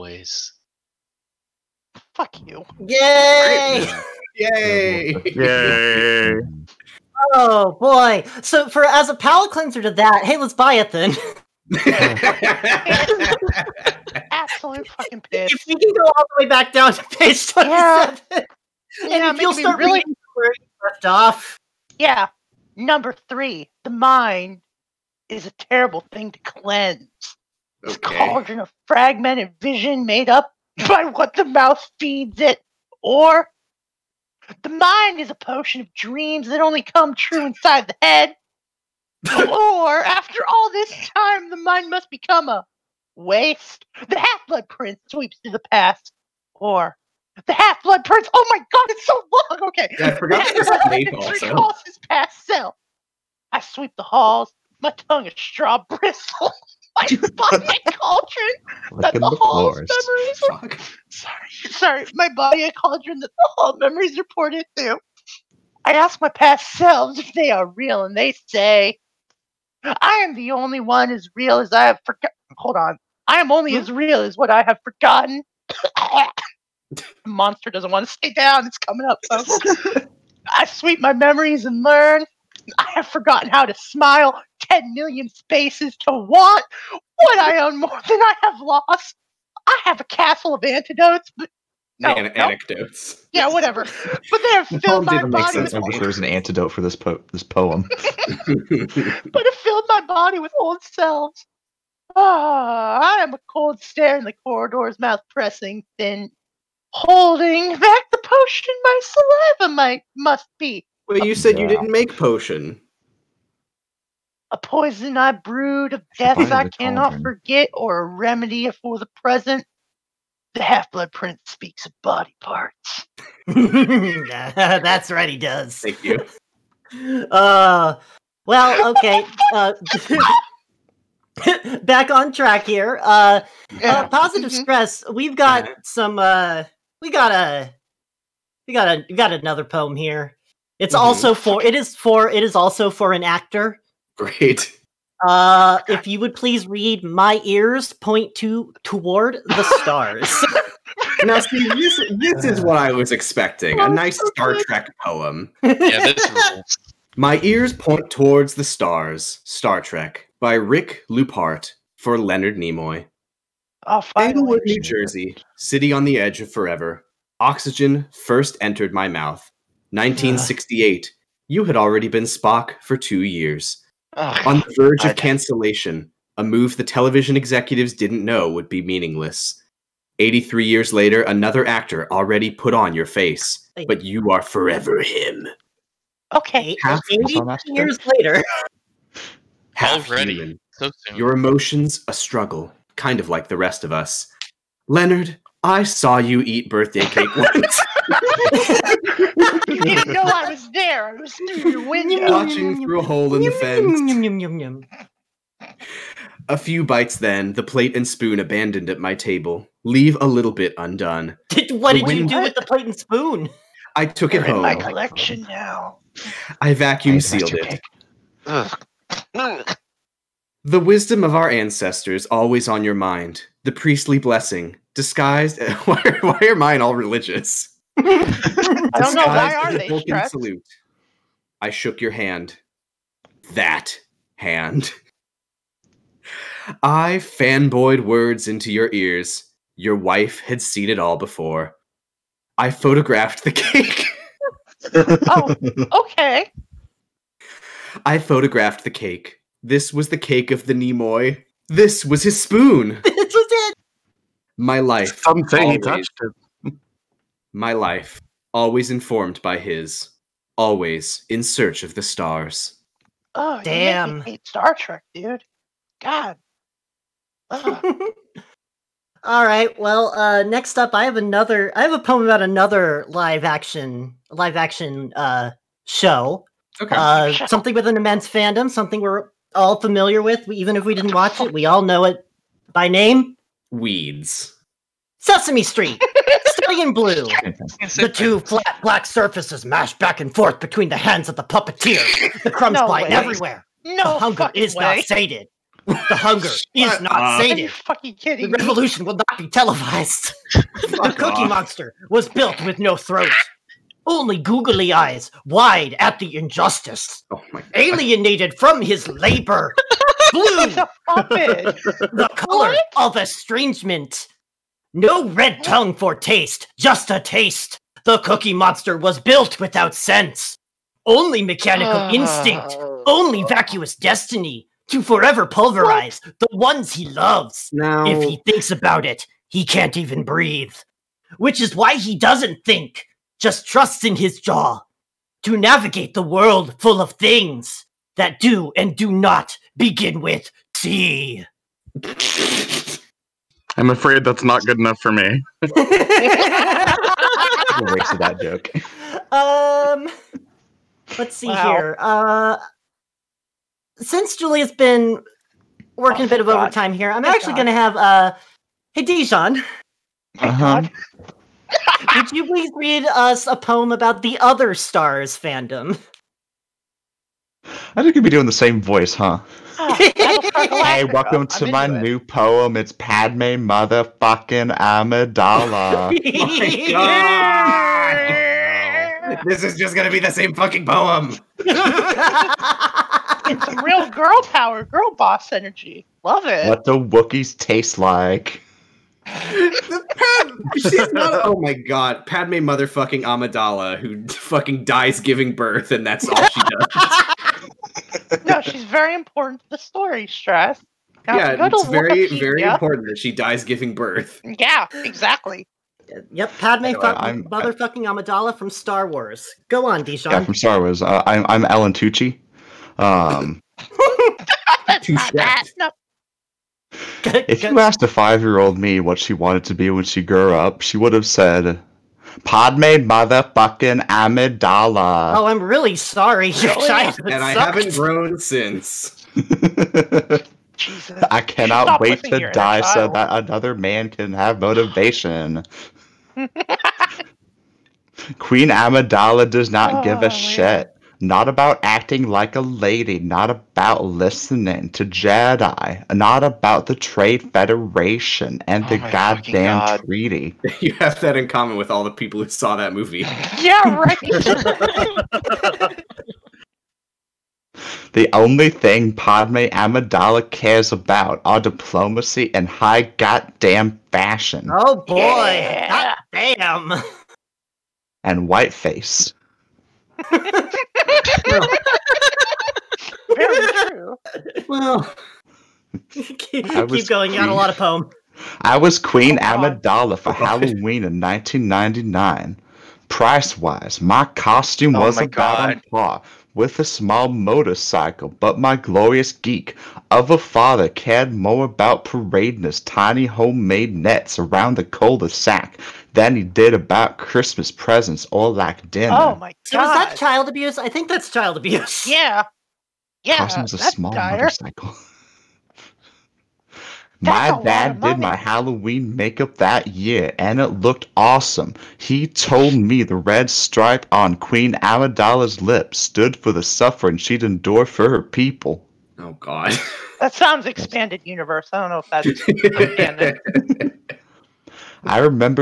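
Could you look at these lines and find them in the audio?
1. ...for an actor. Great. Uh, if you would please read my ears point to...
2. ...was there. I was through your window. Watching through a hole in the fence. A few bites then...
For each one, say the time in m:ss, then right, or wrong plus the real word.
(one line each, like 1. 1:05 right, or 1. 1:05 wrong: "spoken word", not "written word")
1. 2:22 right
2. 3:20 right.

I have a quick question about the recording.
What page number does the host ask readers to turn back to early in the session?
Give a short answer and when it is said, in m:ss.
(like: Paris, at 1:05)
27, at 0:17.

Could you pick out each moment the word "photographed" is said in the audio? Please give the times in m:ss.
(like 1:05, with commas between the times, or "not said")
4:02, 4:08.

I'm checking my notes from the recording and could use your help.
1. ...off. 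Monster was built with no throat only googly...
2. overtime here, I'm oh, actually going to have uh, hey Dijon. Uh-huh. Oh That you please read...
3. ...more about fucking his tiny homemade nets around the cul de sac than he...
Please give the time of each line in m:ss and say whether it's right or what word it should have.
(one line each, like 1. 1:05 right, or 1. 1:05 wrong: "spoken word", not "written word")
1. 5:01 right
2. 5:56 wrong: "Would", not "That"
3. 8:11 wrong: "parading", not "fucking".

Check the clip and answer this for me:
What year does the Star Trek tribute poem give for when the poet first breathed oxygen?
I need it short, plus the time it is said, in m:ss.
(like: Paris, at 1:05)
1968, at 2:49.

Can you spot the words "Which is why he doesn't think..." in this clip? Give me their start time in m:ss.
5:31.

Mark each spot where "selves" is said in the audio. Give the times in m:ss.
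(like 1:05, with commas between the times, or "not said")
1:06, 1:40.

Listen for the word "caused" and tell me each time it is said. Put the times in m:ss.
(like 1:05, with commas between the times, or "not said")
not said.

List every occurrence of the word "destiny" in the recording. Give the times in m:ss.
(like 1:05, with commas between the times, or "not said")
5:23.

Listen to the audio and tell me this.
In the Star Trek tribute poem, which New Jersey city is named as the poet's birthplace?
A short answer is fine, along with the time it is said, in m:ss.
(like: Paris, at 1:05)
Englewood, at 2:44.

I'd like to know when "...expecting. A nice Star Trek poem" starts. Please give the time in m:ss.
2:33.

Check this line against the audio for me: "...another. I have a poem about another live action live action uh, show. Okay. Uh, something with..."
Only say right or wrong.
right.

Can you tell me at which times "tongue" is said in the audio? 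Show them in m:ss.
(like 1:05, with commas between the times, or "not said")
0:55, 5:15.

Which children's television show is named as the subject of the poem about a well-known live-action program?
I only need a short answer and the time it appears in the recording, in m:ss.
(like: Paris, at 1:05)
Sesame Street, at 4:45.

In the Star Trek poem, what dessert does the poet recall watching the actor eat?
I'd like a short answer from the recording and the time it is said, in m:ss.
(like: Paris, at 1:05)
birthday cake, at 3:16.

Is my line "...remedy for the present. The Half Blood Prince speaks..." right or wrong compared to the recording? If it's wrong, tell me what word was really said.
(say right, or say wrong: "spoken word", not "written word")
right.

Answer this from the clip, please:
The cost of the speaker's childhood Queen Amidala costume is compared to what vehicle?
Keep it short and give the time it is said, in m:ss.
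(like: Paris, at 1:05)
small motorcycle, at 8:06.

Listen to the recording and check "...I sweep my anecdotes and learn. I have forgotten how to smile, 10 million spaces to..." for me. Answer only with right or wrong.
wrong.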